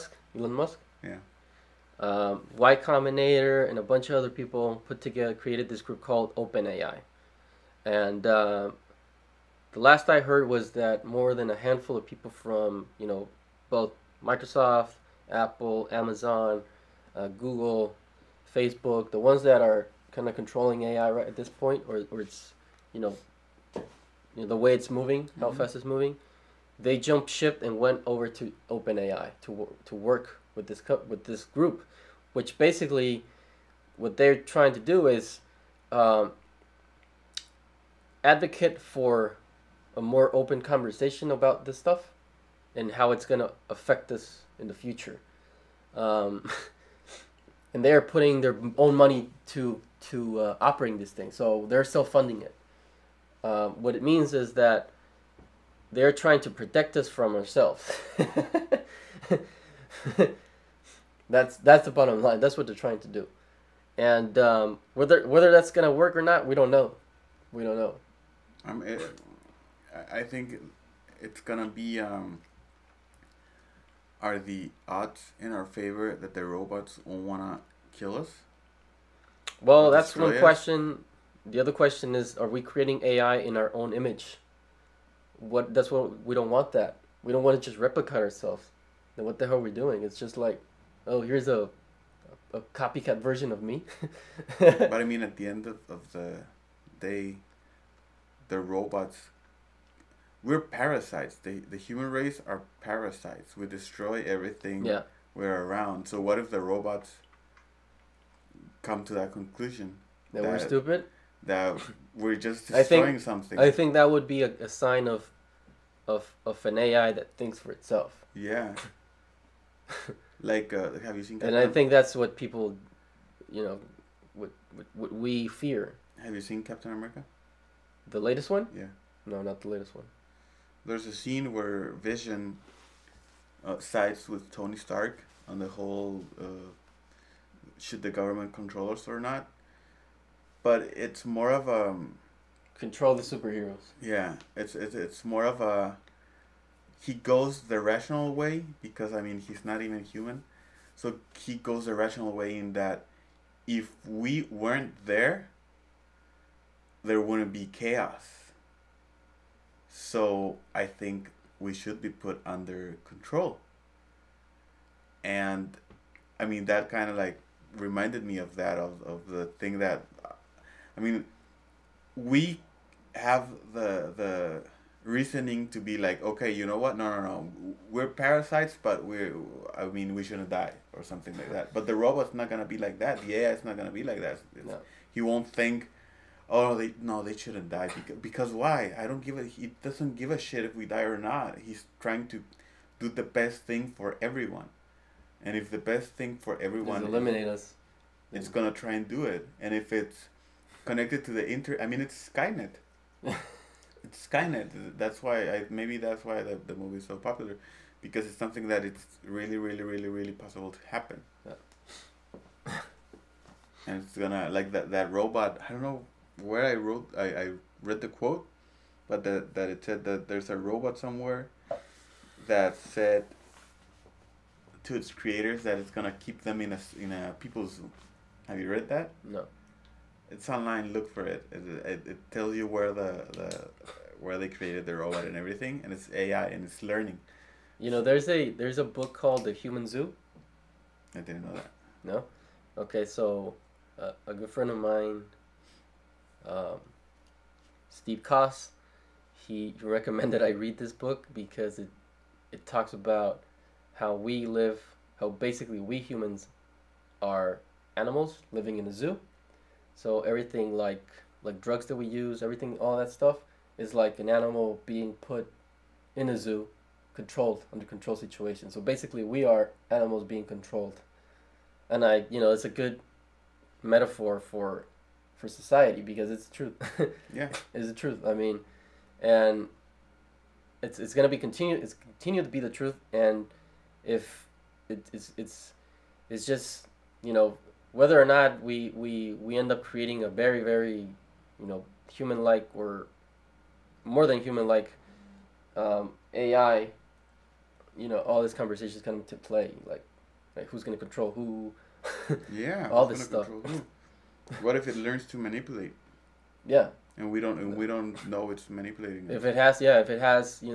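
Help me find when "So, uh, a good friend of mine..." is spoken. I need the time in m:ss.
4:03.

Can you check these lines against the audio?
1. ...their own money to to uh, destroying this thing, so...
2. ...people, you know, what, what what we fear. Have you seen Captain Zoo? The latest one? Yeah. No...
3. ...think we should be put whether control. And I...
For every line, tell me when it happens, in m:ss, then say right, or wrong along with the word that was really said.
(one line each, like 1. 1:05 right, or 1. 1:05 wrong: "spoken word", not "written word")
1. 0:48 wrong: "operating", not "destroying"
2. 2:02 wrong: "America", not "Zoo"
3. 2:40 wrong: "under", not "whether".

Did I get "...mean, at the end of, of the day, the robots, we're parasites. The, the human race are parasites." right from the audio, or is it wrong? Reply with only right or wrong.
right.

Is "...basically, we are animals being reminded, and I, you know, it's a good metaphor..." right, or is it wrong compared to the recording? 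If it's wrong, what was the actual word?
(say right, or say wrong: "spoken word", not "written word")
wrong: "controlled", not "reminded".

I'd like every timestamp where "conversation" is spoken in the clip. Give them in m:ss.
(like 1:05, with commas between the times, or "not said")
0:40, 4:58.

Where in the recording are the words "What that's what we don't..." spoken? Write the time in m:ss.
1:25.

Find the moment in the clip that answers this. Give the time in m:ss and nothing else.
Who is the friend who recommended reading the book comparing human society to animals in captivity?
4:07.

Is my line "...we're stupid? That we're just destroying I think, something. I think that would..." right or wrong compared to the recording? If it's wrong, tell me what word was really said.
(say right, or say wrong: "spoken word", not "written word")
right.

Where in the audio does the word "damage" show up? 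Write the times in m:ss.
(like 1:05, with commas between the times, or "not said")
not said.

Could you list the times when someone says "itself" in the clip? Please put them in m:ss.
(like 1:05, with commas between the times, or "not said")
1:57.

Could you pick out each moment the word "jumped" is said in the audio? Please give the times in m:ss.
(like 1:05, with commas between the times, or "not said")
0:26.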